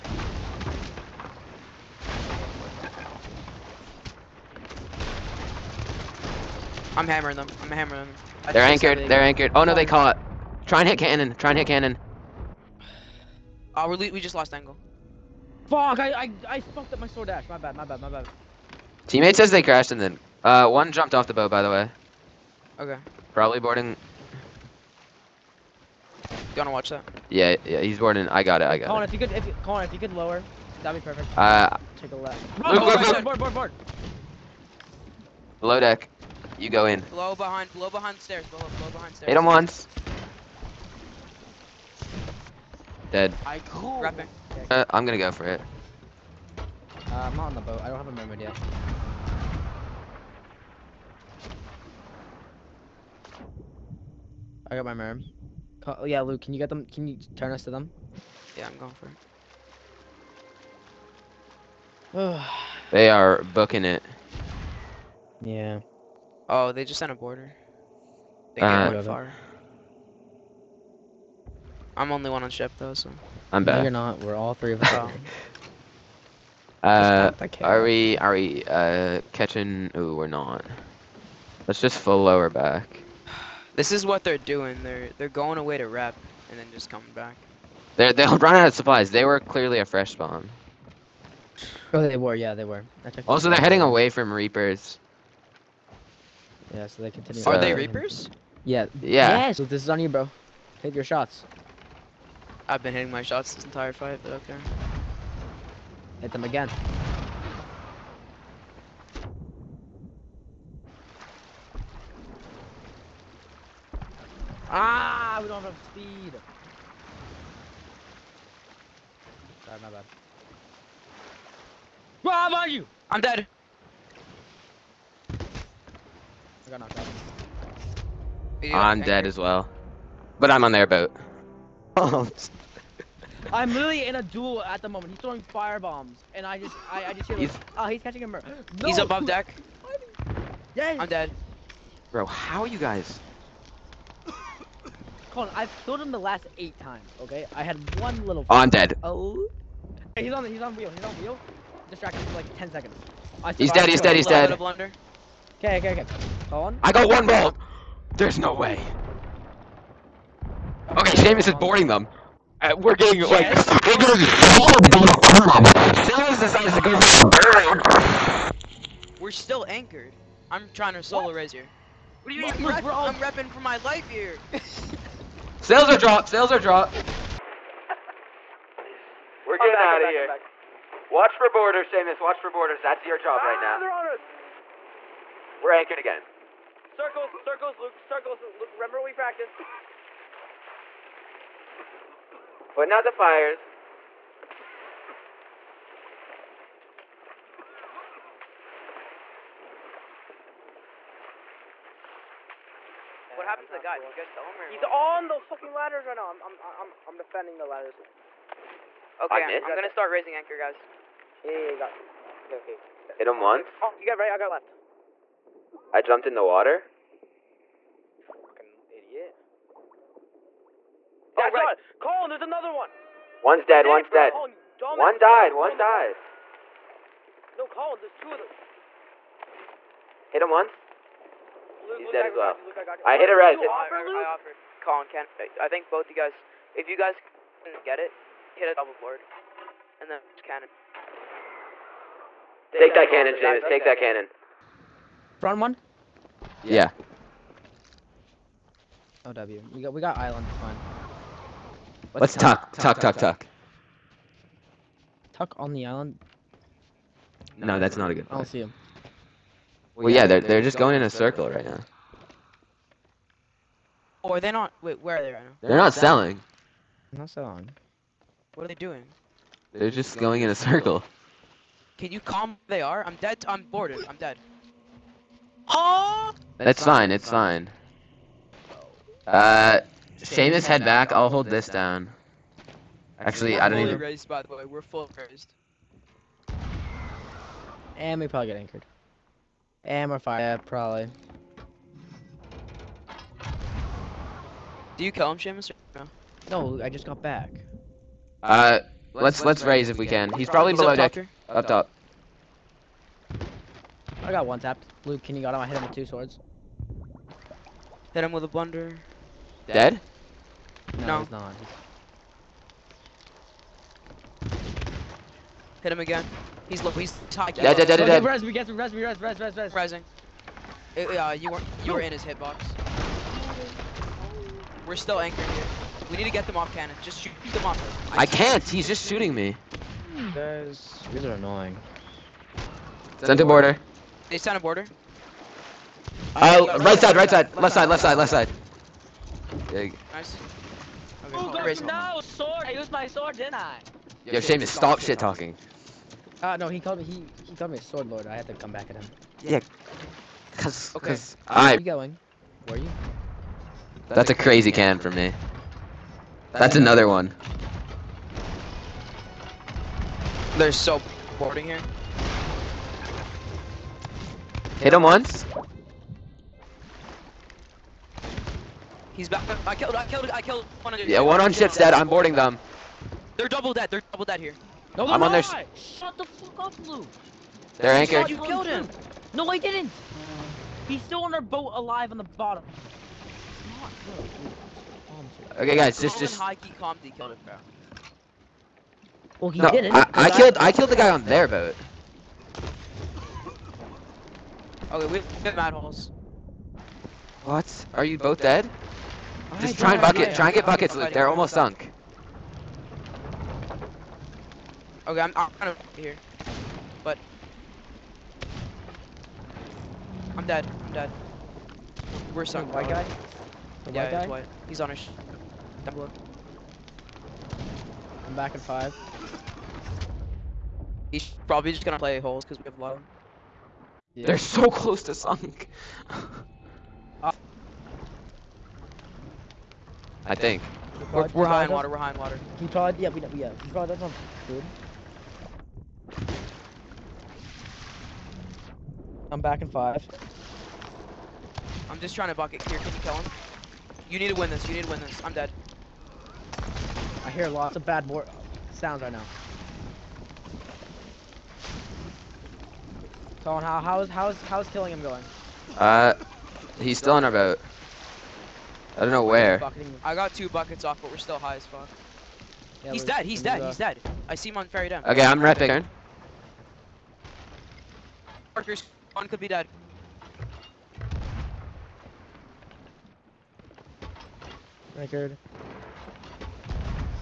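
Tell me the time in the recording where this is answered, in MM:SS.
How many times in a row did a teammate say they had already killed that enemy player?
02:26.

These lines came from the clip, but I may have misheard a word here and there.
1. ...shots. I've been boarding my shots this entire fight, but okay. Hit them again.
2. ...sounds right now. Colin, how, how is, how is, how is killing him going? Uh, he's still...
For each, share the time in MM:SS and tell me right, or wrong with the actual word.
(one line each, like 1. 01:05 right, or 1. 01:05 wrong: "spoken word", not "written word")
1. 01:41 wrong: "hitting", not "boarding"
2. 07:28 right.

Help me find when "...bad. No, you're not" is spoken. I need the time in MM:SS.
01:13.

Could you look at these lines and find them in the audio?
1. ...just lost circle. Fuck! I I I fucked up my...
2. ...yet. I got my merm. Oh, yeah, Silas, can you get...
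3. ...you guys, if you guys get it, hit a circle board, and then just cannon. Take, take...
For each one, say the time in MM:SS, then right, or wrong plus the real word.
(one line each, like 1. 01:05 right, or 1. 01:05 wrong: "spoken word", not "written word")
1. 00:14 wrong: "angle", not "circle"
2. 00:48 wrong: "Luke", not "Silas"
3. 03:56 wrong: "double", not "circle".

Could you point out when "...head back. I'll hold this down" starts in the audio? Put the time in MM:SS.
04:40.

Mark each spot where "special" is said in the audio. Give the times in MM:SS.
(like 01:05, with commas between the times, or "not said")
not said.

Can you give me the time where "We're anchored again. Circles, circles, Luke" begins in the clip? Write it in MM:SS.
03:05.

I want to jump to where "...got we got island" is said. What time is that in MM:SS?
04:09.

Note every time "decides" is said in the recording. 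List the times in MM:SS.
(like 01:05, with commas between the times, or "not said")
02:46.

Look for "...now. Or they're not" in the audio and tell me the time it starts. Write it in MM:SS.
04:21.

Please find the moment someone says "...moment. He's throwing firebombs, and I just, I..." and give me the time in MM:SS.
02:14.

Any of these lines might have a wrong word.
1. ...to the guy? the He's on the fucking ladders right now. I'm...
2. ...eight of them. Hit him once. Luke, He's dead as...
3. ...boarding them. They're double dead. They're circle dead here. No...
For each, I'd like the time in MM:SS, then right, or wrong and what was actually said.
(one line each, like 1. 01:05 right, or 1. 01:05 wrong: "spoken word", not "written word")
1. 03:23 right
2. 03:48 wrong: "two", not "eight"
3. 06:12 wrong: "double", not "circle".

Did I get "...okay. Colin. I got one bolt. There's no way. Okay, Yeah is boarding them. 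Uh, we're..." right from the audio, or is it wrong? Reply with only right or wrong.
wrong.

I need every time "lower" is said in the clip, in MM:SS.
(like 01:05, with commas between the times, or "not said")
00:30, 01:22.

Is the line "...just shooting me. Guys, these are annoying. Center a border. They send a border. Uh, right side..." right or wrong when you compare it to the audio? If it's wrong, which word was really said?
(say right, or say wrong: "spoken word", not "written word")
right.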